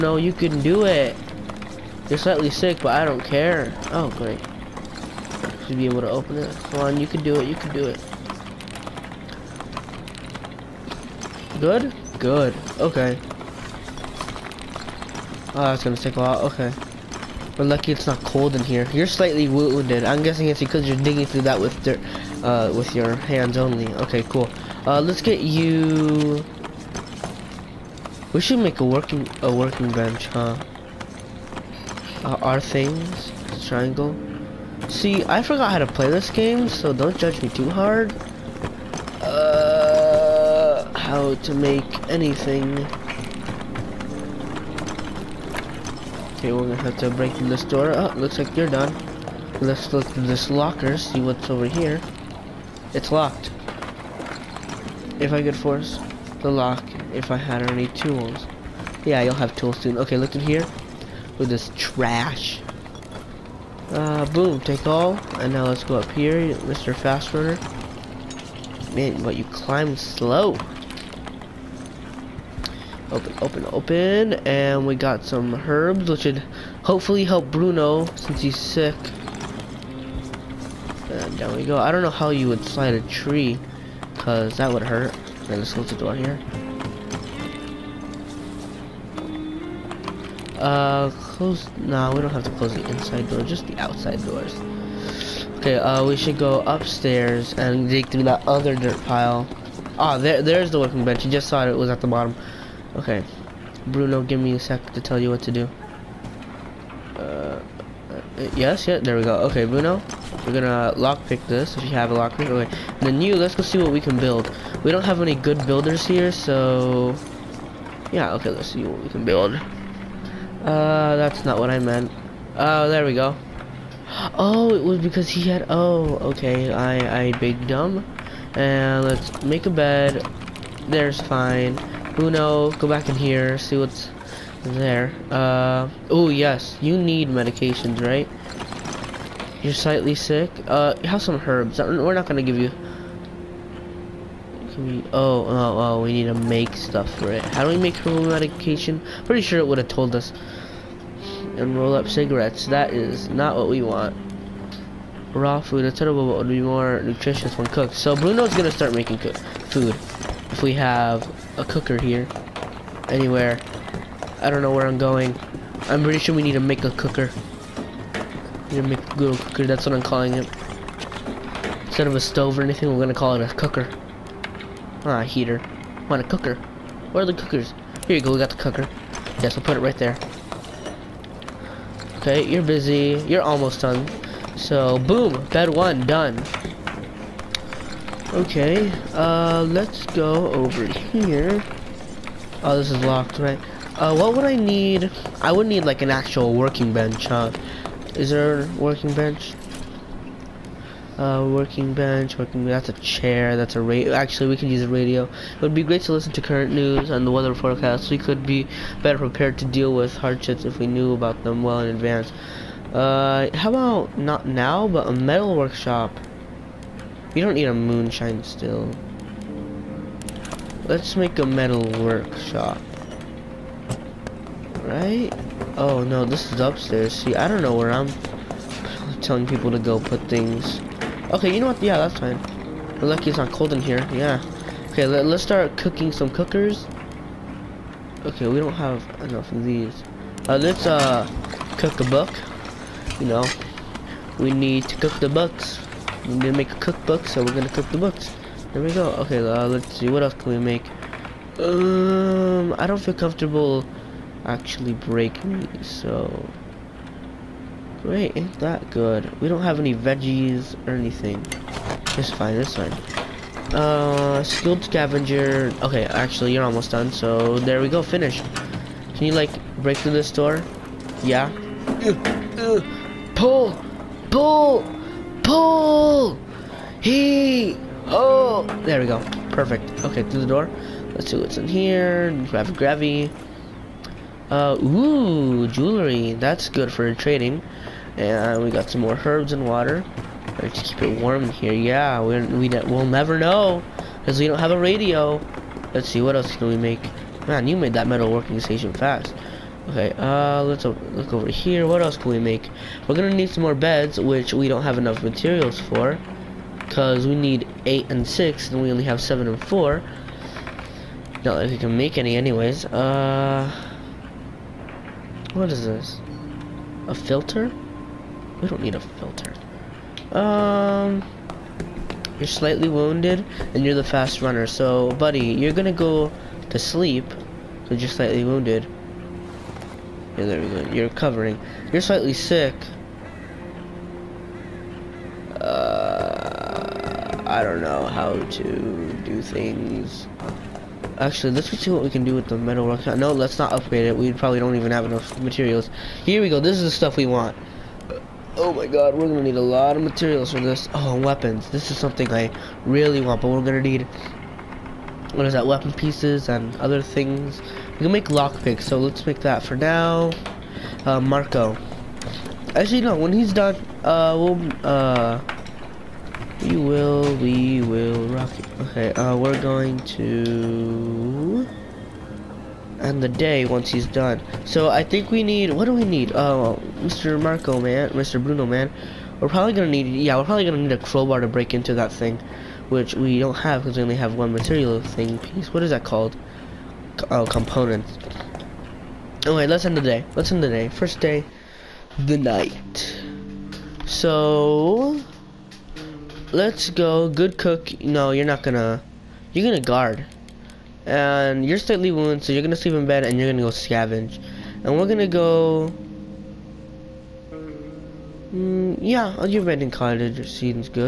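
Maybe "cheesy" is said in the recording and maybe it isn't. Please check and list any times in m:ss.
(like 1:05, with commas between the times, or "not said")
not said.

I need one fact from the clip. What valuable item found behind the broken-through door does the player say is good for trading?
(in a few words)
jewelry.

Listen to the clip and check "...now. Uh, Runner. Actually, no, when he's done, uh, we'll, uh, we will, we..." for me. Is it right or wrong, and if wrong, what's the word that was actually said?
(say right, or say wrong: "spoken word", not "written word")
wrong: "Marko", not "Runner".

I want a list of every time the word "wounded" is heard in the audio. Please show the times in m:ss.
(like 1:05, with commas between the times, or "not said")
0:19, 5:22, 5:28, 6:42.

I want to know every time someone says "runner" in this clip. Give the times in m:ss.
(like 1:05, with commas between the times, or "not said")
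1:07, 5:24.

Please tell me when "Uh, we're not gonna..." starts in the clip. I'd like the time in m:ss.
2:21.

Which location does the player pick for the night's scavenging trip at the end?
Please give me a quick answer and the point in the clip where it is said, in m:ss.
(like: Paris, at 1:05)
abandoned cottage, at 6:49.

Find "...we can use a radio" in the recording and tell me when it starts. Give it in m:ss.
3:24.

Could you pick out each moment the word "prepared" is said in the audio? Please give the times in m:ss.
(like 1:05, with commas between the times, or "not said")
3:29.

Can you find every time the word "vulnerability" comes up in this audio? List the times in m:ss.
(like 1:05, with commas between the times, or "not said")
not said.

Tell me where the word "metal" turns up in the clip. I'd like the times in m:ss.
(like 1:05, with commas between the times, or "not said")
3:35, 3:41, 4:58, 5:42.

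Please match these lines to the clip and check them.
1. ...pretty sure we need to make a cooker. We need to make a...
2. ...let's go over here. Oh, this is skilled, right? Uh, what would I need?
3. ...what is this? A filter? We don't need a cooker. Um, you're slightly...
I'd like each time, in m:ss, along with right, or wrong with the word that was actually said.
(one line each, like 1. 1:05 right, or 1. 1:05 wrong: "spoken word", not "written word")
1. 2:46 right
2. 3:09 wrong: "locked", not "skilled"
3. 5:15 wrong: "filter", not "cooker".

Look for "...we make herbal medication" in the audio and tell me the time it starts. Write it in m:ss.
2:27.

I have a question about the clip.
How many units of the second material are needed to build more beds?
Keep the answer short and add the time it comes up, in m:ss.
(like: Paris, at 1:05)
6, at 5:07.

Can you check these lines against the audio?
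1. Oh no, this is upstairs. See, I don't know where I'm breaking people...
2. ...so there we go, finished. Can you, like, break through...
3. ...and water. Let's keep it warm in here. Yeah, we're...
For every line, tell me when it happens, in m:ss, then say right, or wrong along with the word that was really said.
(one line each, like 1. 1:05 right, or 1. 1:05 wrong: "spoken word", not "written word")
1. 3:45 wrong: "telling", not "breaking"
2. 4:27 right
3. 4:49 right.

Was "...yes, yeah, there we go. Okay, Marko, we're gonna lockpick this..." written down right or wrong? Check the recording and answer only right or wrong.
wrong.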